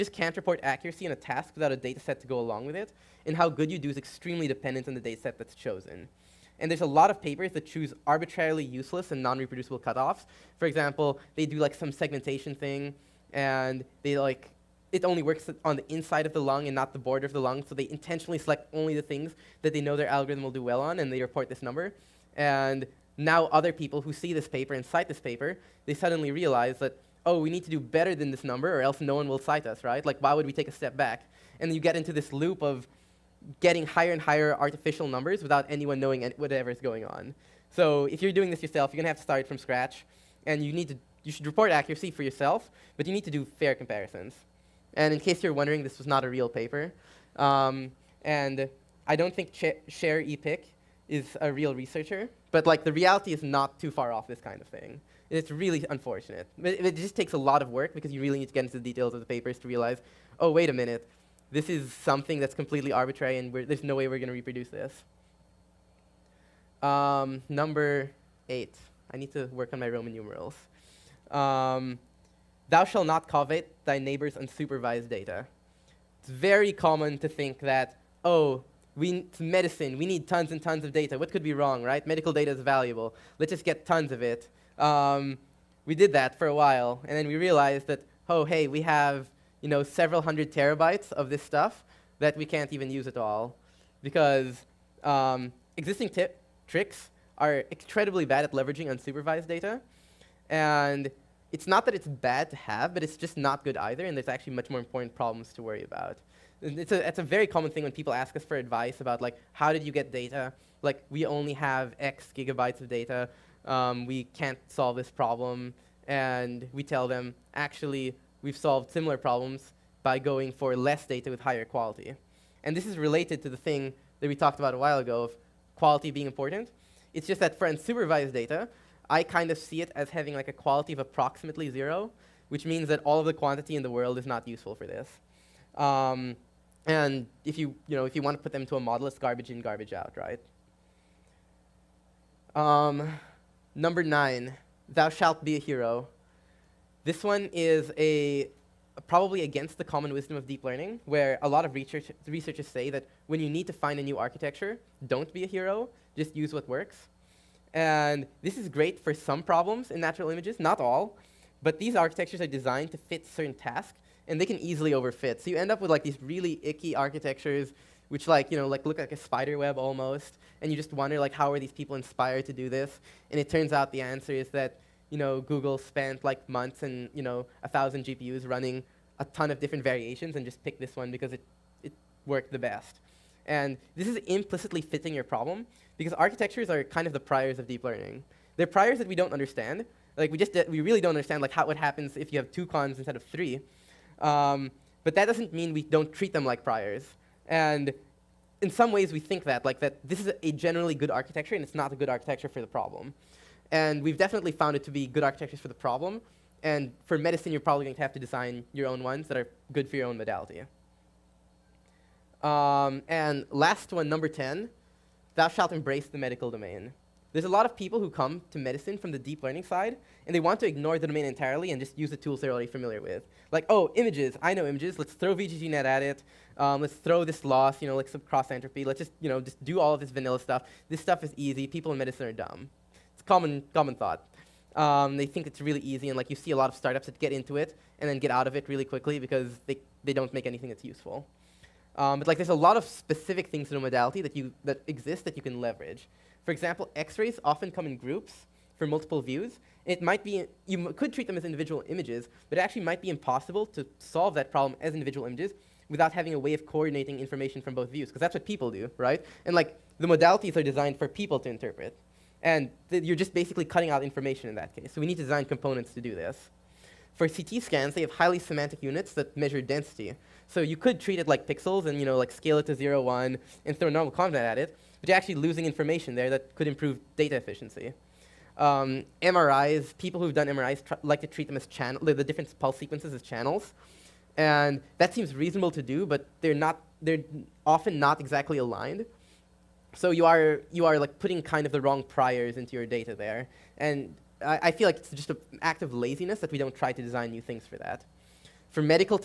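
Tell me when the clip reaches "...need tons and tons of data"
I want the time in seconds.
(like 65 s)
80 s.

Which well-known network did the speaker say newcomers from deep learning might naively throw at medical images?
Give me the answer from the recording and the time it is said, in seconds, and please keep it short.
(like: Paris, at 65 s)
VGGNet, at 225 s.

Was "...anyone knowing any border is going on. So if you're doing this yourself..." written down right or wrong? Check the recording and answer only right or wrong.
wrong.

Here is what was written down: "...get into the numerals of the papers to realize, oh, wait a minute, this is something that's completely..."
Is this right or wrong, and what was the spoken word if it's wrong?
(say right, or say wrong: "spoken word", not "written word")
wrong: "details", not "numerals".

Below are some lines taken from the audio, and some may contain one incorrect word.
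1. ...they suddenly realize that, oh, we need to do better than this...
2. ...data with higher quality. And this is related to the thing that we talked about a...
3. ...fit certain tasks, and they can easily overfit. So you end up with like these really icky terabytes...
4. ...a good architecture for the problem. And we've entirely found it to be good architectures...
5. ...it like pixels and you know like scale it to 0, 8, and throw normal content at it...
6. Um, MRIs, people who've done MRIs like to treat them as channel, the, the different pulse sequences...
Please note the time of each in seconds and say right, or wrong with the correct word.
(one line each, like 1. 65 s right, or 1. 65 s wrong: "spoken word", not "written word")
1. 25 s right
2. 121 s right
3. 162 s wrong: "architectures", not "terabytes"
4. 201 s wrong: "definitely", not "entirely"
5. 271 s wrong: "1", not "8"
6. 278 s right.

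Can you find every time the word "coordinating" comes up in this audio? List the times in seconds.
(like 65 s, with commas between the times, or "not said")
256 s.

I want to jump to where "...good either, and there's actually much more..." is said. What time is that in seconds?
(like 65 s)
103 s.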